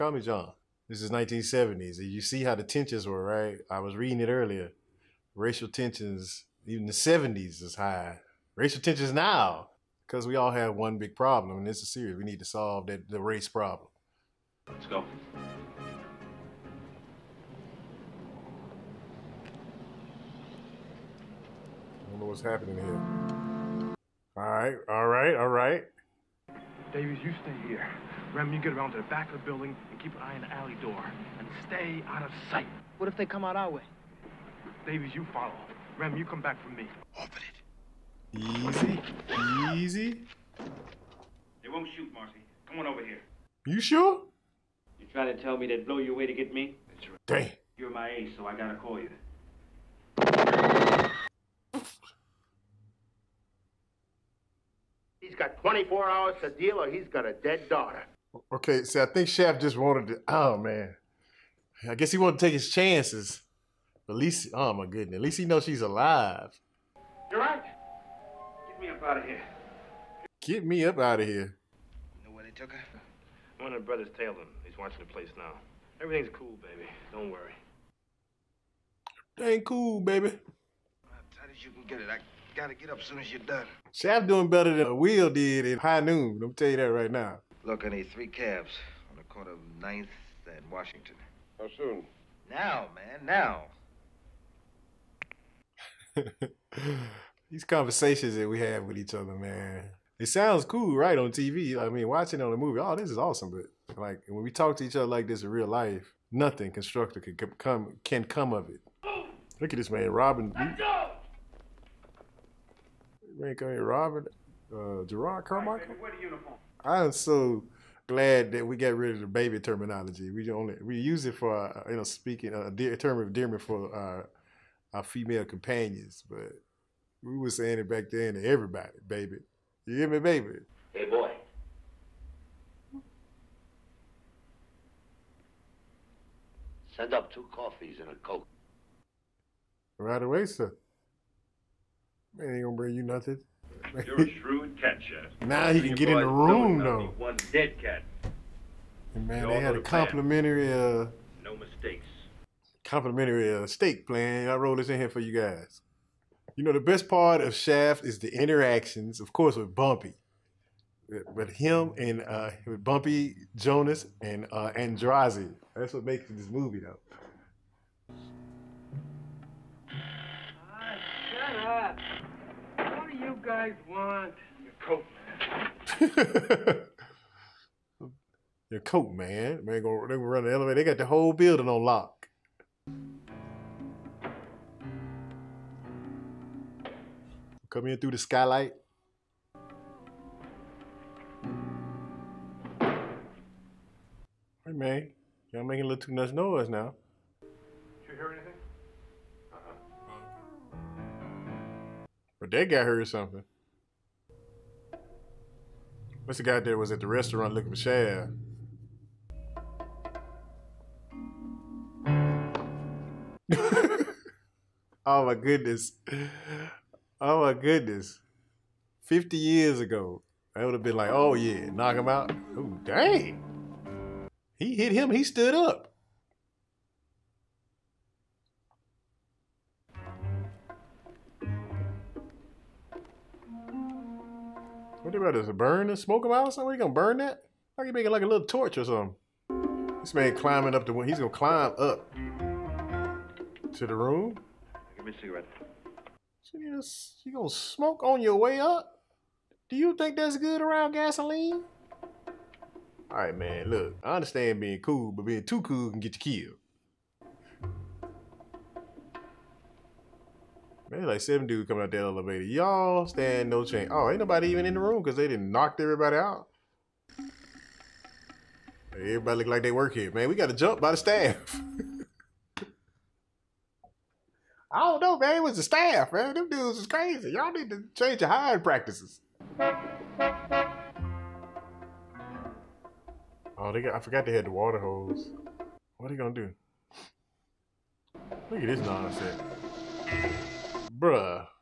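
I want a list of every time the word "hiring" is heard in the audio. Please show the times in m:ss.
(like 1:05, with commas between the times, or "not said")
4:38.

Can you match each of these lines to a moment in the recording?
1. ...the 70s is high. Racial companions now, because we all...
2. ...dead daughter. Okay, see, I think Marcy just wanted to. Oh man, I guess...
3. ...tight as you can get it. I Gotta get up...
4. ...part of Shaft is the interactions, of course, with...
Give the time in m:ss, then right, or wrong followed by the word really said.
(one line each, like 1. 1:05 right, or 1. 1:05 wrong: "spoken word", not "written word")
1. 0:06 wrong: "tensions", not "companions"
2. 0:57 wrong: "Shaft", not "Marcy"
3. 1:21 right
4. 2:37 right.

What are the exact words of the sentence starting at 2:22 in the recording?
Man, ain't gonna bring you nothing.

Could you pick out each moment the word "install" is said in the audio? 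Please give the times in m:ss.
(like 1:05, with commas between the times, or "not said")
not said.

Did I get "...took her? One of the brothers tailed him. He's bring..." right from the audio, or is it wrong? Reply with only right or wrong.
wrong.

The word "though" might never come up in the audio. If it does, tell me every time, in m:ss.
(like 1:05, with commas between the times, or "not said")
2:26, 2:46.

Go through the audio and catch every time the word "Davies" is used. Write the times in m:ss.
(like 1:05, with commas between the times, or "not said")
0:26, 0:34.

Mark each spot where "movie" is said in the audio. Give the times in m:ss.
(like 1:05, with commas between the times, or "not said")
1:42, 2:46.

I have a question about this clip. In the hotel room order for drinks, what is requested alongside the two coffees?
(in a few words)
a coke.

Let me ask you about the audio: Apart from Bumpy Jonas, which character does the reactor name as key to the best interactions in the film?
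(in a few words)
Androzzi.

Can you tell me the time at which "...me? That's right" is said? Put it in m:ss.
0:46.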